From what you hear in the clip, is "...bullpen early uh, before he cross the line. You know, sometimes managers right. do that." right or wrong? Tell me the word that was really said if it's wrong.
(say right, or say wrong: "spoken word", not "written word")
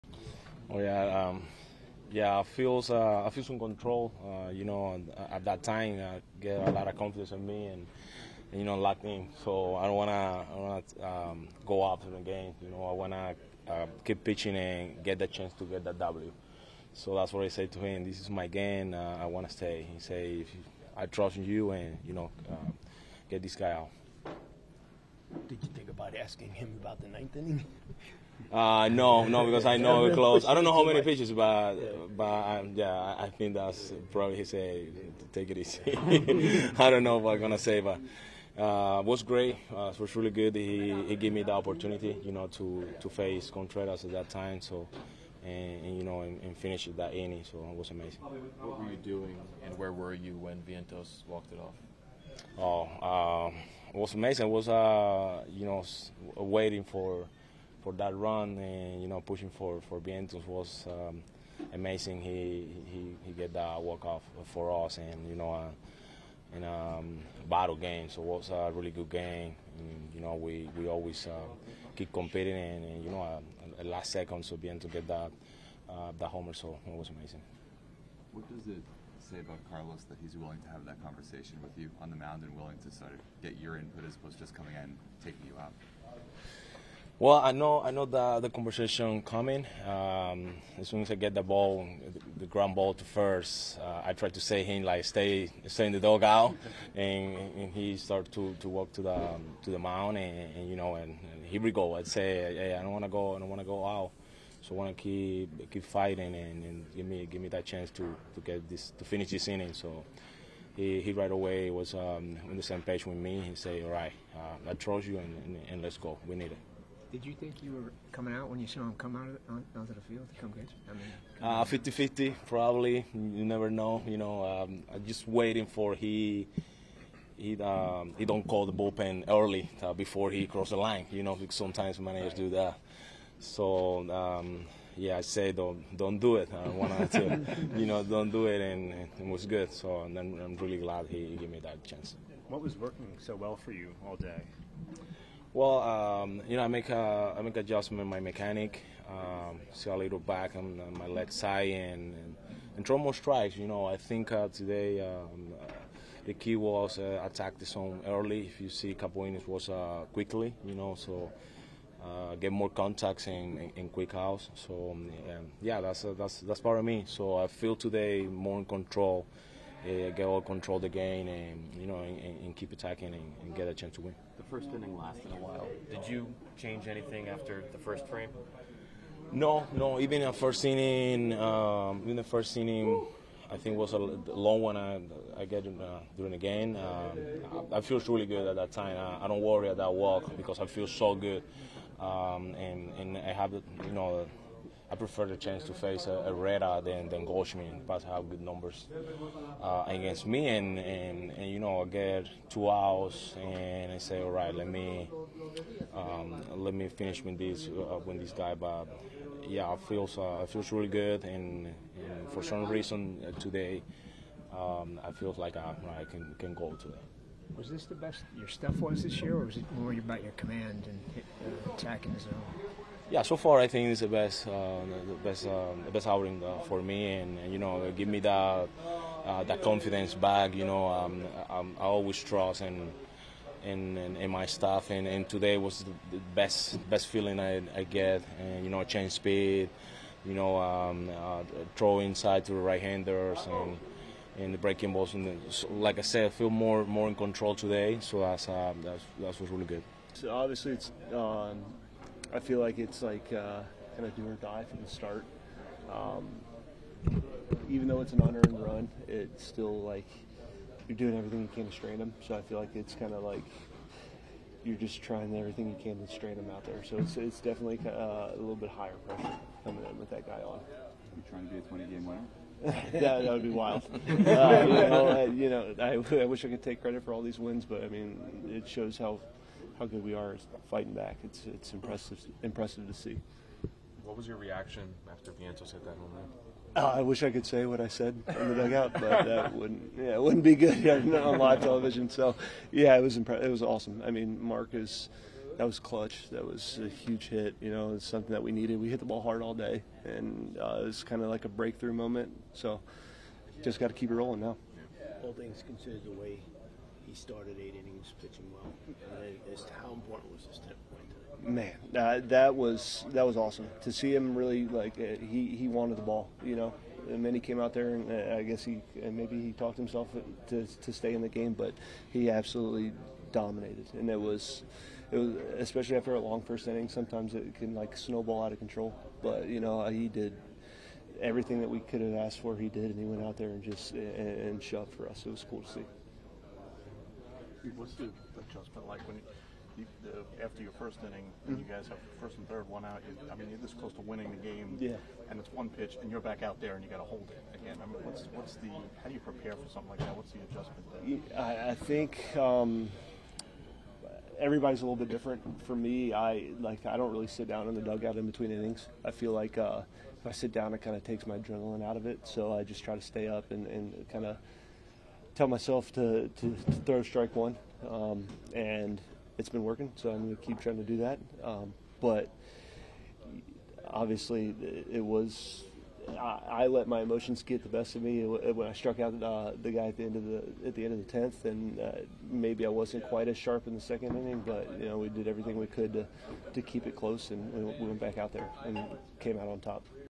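right.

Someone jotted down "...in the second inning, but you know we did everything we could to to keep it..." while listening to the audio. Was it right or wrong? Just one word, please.
right.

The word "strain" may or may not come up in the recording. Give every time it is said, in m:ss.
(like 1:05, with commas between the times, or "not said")
4:21, 4:26.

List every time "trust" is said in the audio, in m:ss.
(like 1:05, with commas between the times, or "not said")
0:21, 1:54, 3:52.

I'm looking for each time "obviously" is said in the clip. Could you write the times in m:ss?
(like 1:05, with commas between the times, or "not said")
4:10, 6:13.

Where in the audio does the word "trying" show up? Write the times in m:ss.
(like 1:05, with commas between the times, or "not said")
4:25, 4:31, 6:10.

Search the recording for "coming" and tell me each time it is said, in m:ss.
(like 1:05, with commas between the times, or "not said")
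1:24, 1:29, 1:58, 4:29.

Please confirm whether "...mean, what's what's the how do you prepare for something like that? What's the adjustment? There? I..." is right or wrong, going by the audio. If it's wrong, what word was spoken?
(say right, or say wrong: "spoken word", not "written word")
right.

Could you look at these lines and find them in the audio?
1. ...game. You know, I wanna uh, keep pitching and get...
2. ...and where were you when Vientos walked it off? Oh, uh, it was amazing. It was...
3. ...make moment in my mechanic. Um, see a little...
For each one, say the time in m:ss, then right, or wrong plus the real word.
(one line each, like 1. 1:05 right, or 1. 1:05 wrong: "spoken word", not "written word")
1. 0:12 right
2. 0:49 right
3. 2:27 wrong: "adjustment", not "moment".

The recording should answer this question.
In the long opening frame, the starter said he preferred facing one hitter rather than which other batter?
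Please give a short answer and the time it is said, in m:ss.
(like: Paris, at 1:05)
Goldschmidt, at 3:17.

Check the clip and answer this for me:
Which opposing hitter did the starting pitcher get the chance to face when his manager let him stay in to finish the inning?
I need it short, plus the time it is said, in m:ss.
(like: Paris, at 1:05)
Contreras, at 0:43.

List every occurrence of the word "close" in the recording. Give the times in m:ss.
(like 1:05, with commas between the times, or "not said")
0:30, 5:43, 6:26.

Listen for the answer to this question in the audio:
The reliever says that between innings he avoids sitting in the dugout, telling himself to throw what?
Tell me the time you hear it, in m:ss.
6:07.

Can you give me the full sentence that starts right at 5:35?
It was cool to see what's the adjustment like when you, the, after your first inning, when you mm-hmm.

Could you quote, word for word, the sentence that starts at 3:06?
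Um, I, I feel really good at that time.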